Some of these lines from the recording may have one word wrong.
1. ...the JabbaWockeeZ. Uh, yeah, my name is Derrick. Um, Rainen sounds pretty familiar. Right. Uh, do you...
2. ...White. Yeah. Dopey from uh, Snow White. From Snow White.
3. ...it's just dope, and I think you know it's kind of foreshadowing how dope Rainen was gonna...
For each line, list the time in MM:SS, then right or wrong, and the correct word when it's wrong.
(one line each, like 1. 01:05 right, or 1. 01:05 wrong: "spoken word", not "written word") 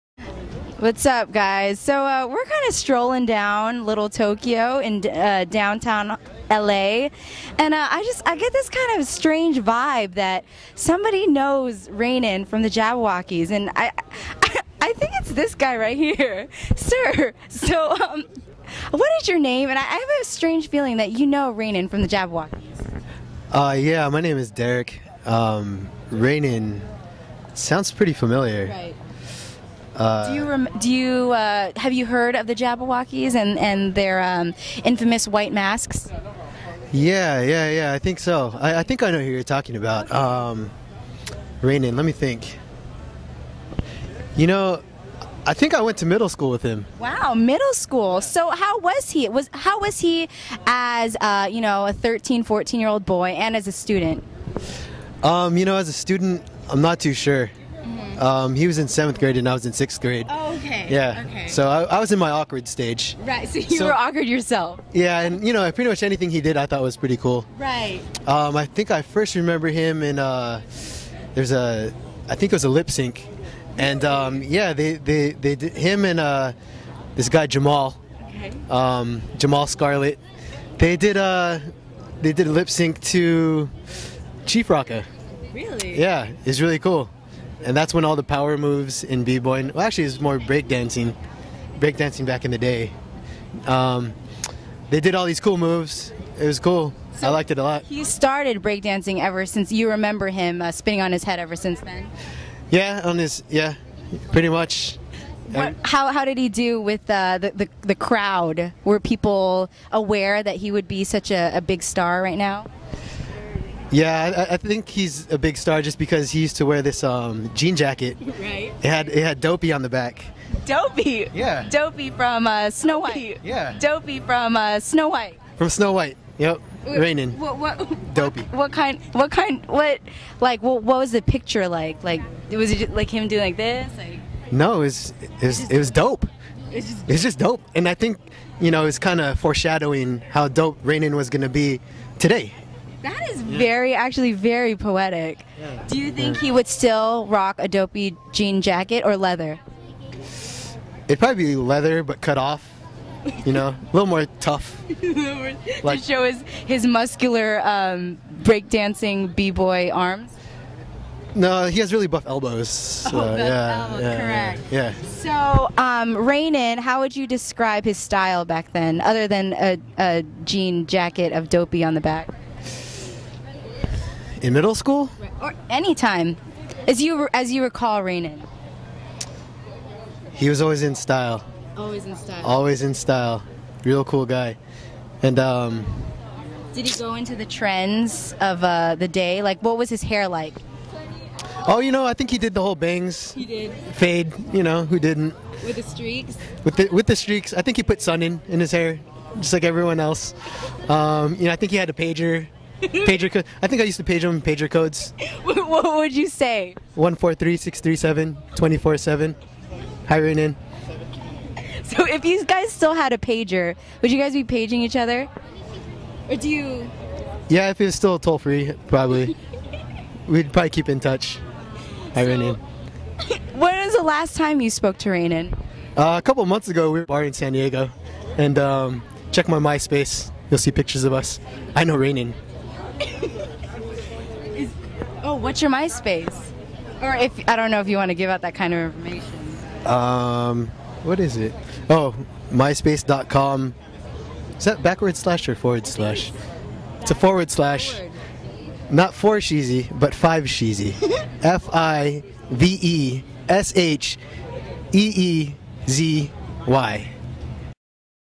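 1. 00:22 right
2. 02:02 right
3. 02:17 right.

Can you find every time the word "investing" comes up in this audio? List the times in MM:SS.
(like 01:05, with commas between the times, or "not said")
not said.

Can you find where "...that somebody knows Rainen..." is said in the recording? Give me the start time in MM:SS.
00:10.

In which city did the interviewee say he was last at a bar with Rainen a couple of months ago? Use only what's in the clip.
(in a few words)
San Diego.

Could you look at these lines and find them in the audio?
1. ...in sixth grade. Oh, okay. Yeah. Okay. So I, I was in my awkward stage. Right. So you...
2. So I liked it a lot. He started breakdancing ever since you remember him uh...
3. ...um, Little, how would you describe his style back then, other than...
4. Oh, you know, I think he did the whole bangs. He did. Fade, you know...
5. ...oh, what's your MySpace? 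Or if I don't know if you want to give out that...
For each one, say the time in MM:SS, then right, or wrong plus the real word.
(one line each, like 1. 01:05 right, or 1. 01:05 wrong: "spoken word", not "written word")
1. 00:59 right
2. 01:37 right
3. 02:45 wrong: "Rainen", not "Little"
4. 03:11 right
5. 03:55 right.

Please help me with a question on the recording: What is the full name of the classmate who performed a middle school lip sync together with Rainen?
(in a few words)
Jamal Scarlett.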